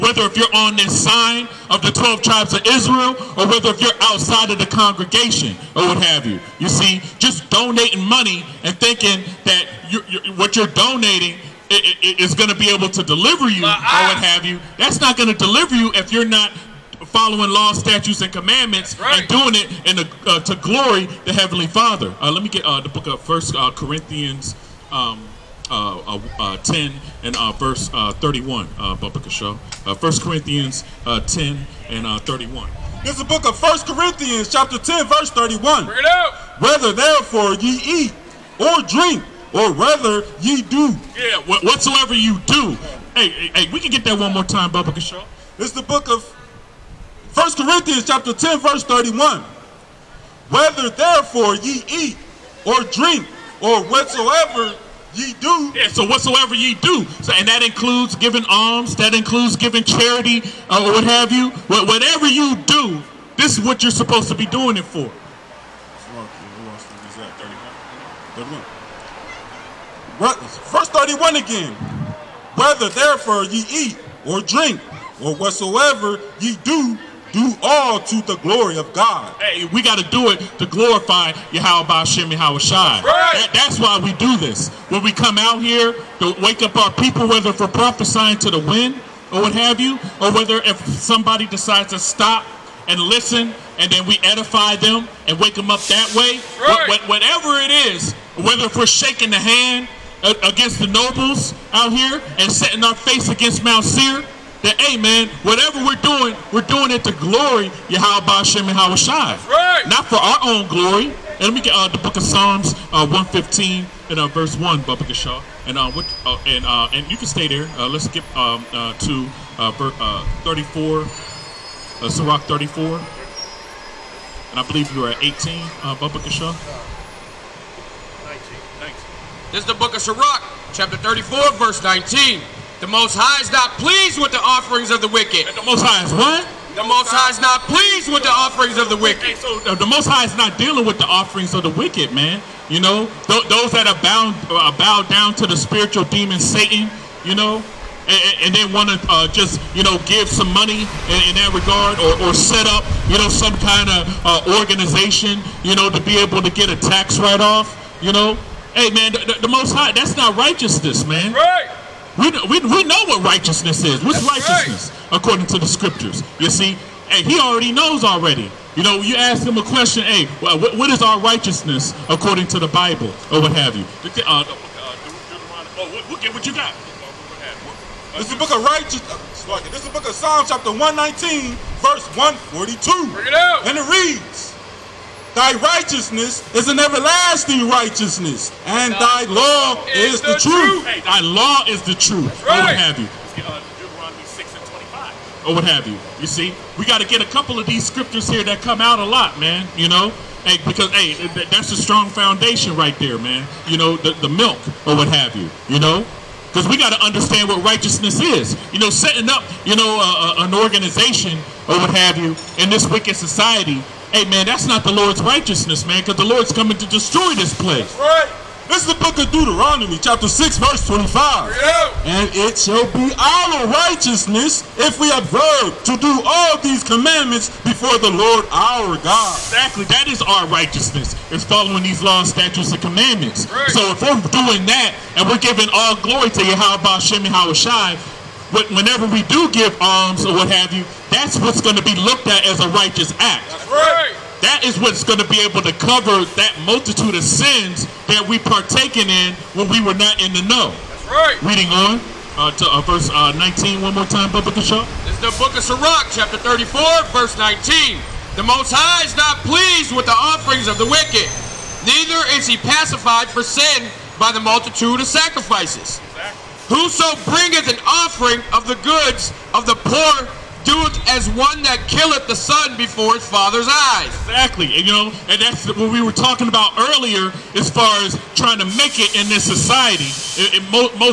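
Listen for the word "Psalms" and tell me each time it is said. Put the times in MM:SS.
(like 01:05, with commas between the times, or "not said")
01:52, 03:00.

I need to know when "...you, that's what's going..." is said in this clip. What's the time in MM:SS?
04:00.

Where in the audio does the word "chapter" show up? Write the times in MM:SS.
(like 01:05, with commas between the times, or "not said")
00:34, 00:48, 02:10, 03:00, 03:39, 04:16.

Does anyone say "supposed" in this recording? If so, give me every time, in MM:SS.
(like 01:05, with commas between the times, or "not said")
01:03.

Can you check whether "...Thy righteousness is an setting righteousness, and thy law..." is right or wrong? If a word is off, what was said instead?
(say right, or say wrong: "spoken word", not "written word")
wrong: "everlasting", not "setting".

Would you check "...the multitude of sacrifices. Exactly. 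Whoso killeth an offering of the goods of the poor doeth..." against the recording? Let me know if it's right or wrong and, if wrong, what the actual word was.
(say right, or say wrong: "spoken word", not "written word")
wrong: "bringeth", not "killeth".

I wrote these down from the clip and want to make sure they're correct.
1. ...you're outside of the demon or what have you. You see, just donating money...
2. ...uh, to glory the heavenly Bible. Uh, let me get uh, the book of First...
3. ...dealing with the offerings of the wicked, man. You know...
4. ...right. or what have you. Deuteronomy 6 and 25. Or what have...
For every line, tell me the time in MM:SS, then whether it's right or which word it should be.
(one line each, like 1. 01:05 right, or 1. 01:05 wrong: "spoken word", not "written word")
1. 00:03 wrong: "congregation", not "demon"
2. 00:20 wrong: "Father", not "Bible"
3. 02:20 right
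4. 03:12 right.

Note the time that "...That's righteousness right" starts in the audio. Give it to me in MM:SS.
02:44.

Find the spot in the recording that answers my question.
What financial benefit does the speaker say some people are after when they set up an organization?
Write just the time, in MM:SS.
02:36.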